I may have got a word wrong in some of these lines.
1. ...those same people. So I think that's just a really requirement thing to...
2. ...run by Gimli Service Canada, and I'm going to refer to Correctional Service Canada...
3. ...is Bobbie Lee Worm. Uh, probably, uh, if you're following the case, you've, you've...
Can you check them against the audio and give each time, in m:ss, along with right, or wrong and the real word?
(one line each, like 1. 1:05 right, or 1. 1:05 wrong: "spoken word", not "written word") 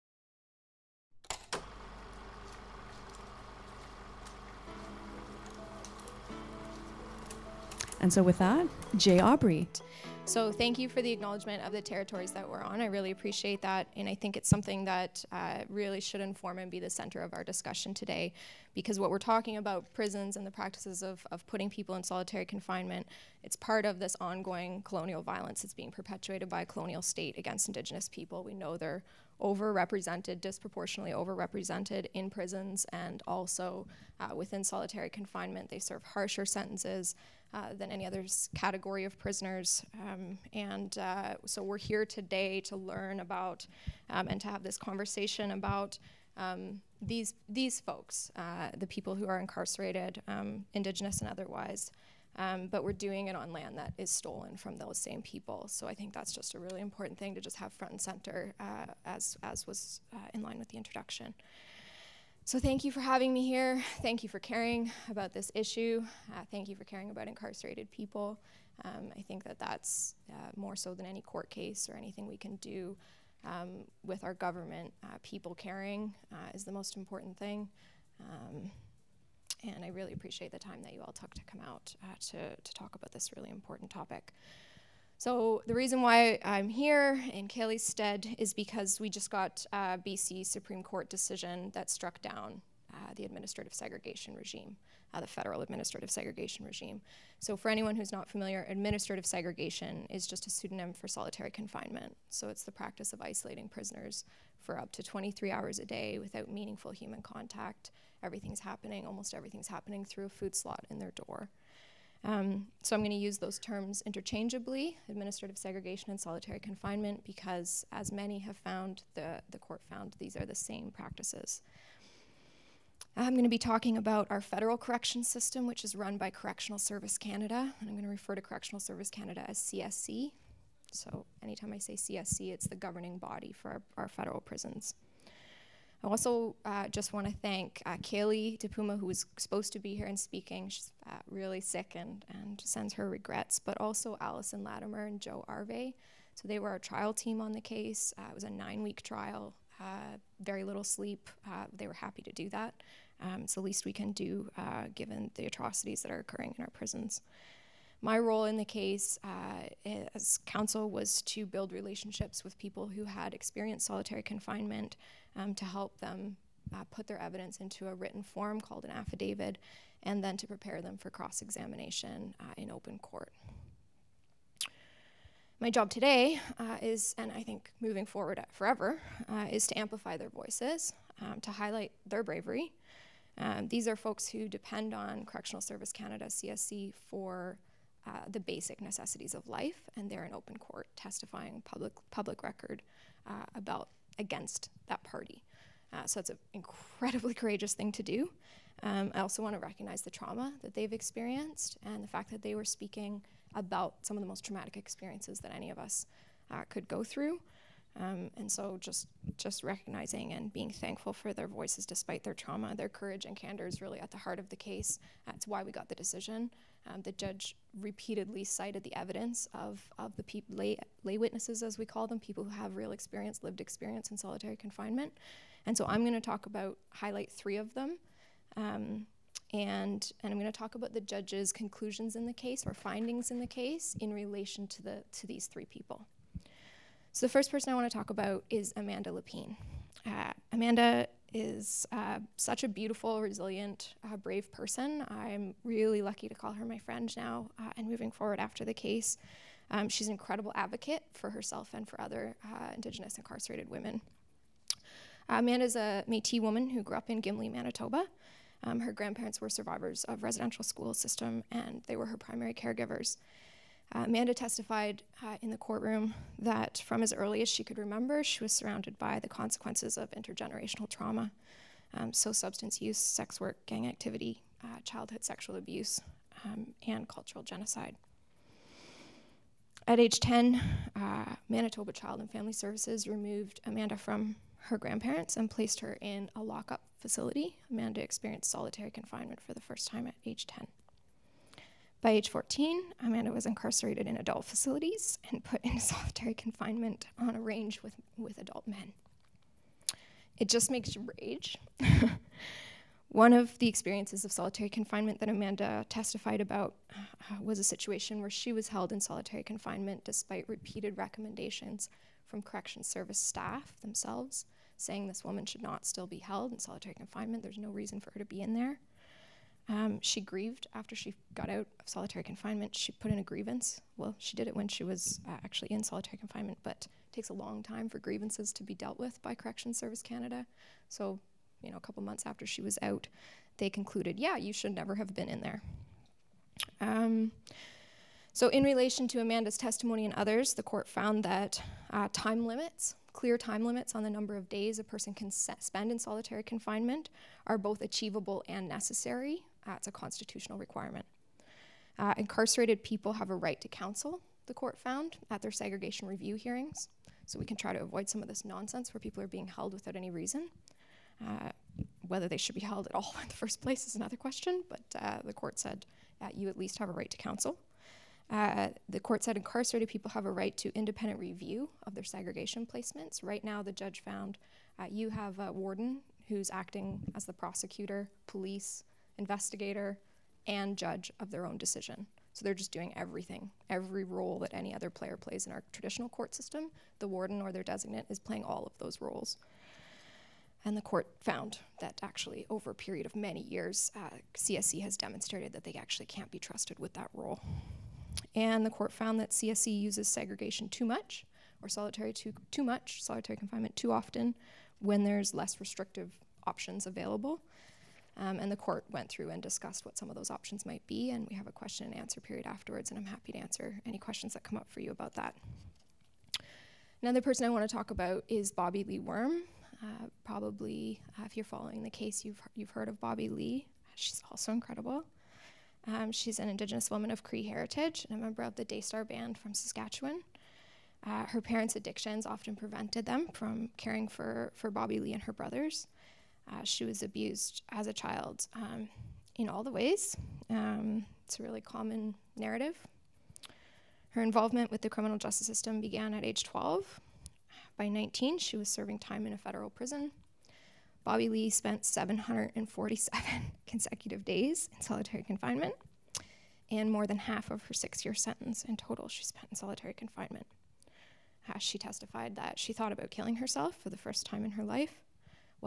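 1. 0:54 wrong: "important", not "requirement"
2. 2:05 wrong: "Correctional", not "Gimli"
3. 6:58 right.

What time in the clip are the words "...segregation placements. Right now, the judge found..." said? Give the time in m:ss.
6:12.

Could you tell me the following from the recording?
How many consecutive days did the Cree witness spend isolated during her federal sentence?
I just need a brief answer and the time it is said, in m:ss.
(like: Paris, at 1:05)
747, at 7:31.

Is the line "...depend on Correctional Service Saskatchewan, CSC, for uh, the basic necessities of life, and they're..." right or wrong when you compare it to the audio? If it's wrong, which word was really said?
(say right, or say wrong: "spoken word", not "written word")
wrong: "Canada", not "Saskatchewan".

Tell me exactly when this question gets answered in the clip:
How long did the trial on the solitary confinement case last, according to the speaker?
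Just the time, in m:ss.
2:28.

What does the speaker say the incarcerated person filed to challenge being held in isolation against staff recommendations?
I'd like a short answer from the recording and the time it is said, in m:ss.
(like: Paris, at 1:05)
a grievance, at 5:23.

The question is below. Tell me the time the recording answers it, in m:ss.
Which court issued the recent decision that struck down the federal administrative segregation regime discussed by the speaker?
1:30.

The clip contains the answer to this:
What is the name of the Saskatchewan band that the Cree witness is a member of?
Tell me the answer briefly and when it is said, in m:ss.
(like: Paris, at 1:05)
Daystar Band, at 7:08.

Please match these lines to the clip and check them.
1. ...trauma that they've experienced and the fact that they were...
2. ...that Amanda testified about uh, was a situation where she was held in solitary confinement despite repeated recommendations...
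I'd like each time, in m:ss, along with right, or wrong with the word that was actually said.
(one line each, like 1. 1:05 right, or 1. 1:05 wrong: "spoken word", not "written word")
1. 3:20 right
2. 5:05 right.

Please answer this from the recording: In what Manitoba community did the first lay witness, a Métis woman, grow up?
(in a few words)
Gimli.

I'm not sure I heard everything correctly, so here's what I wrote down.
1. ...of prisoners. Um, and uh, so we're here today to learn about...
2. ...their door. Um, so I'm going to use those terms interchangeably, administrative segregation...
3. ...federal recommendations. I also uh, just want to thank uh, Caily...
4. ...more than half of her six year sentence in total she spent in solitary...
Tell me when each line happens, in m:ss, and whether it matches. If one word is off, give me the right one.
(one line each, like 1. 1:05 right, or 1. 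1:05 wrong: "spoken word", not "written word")
1. 0:39 right
2. 1:50 right
3. 2:14 wrong: "prisons", not "recommendations"
4. 7:36 right.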